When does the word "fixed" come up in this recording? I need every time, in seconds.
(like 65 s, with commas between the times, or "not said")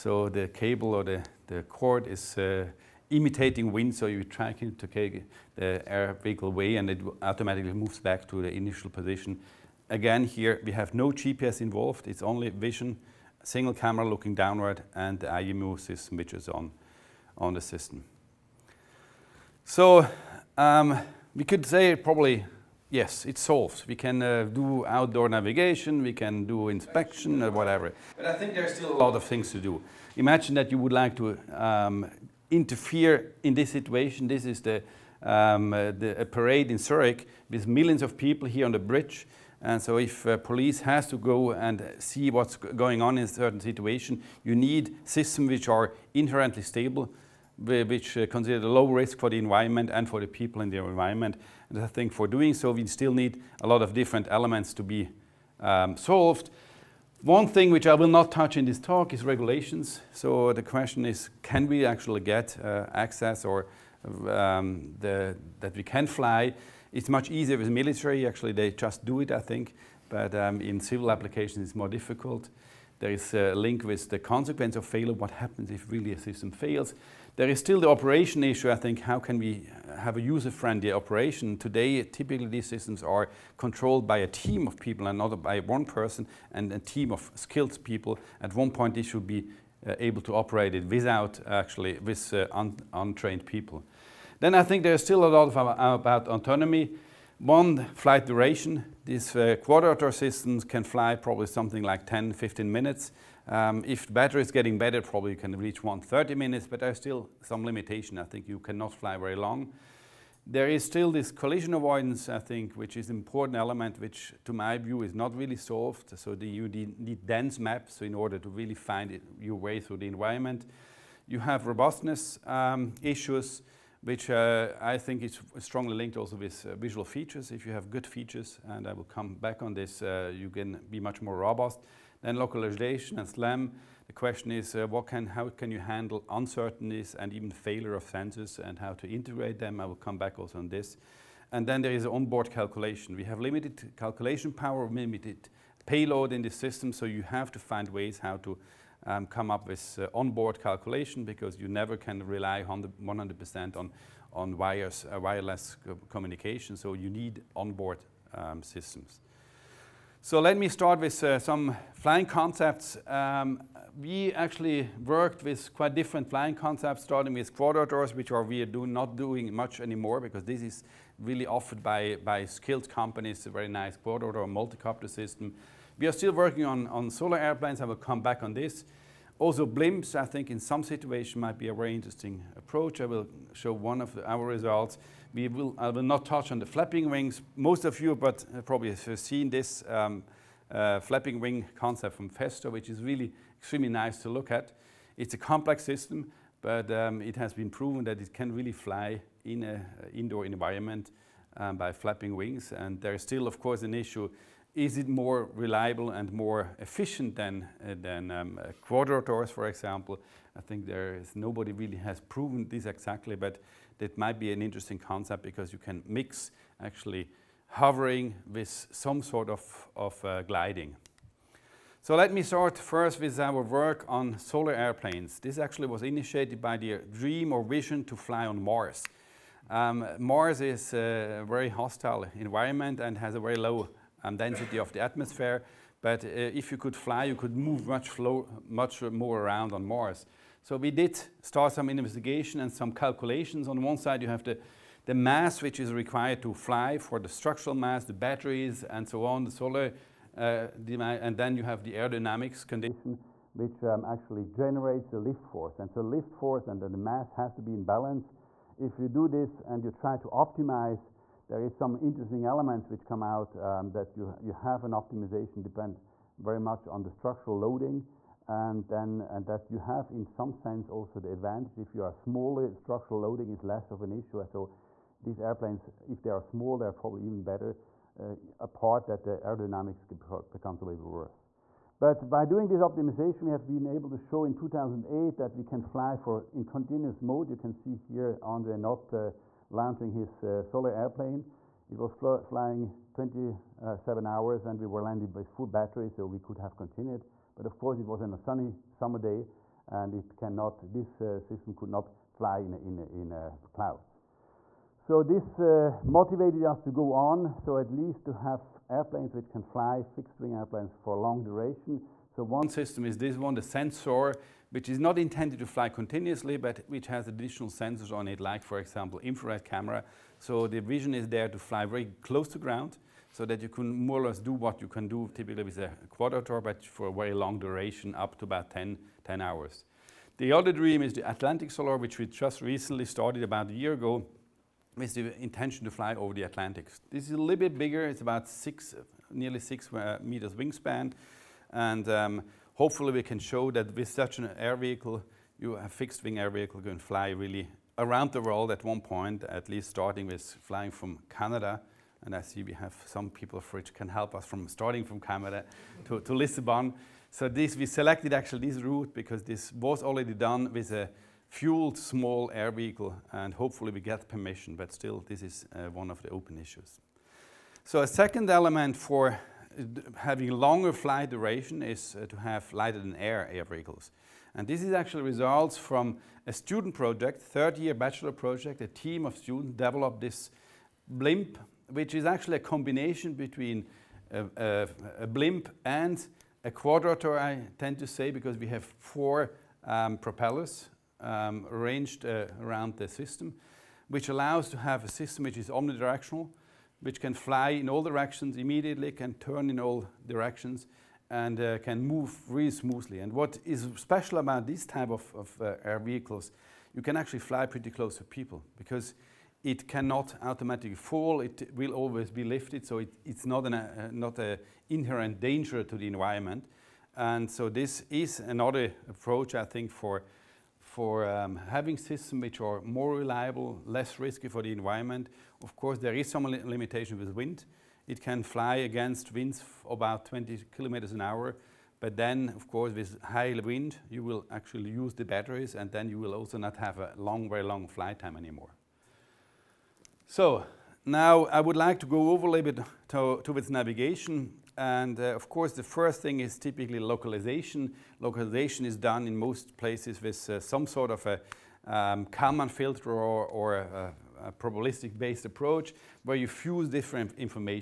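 310 s, 345 s.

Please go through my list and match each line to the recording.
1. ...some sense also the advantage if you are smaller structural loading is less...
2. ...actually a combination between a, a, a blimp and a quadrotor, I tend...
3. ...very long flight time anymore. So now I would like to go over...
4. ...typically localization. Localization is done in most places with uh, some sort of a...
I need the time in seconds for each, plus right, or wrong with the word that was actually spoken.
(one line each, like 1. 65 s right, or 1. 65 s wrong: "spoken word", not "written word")
1. 270 s right
2. 382 s right
3. 437 s right
4. 446 s right.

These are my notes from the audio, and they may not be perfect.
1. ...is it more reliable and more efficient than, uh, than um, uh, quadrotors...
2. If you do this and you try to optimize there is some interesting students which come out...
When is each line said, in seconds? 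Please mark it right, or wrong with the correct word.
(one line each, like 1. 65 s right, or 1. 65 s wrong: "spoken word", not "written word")
1. 204 s right
2. 258 s wrong: "elements", not "students".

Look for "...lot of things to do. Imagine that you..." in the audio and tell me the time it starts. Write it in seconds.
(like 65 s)
28 s.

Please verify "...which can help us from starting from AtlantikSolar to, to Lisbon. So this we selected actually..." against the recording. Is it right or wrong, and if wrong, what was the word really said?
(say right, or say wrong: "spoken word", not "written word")
wrong: "Canada", not "AtlantikSolar".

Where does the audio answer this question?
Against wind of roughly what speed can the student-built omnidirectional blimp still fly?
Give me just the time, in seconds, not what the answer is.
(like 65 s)
430 s.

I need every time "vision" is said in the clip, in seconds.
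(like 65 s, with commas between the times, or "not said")
12 s, 227 s, 320 s.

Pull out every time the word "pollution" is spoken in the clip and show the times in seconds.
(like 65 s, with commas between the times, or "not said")
not said.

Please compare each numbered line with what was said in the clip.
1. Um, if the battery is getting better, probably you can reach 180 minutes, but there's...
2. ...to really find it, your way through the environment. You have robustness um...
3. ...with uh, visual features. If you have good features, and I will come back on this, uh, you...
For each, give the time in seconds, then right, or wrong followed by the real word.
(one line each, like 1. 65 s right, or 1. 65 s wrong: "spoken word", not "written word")
1. 103 s wrong: "130", not "180"
2. 118 s right
3. 126 s right.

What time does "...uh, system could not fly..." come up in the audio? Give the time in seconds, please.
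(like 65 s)
301 s.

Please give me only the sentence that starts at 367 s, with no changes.
So a second element for having longer flight duration is uh, to have lighter than air air vehicles.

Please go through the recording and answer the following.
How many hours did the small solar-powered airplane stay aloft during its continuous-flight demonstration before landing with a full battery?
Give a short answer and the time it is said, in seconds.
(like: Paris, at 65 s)
27, at 293 s.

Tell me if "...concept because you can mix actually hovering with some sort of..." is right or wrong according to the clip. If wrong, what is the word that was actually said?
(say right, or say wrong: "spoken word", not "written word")
right.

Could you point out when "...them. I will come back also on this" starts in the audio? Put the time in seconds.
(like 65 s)
139 s.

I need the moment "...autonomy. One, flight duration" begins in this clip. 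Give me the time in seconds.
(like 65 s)
96 s.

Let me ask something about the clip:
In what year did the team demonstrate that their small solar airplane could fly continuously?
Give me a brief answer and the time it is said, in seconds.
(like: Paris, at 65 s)
2008, at 284 s.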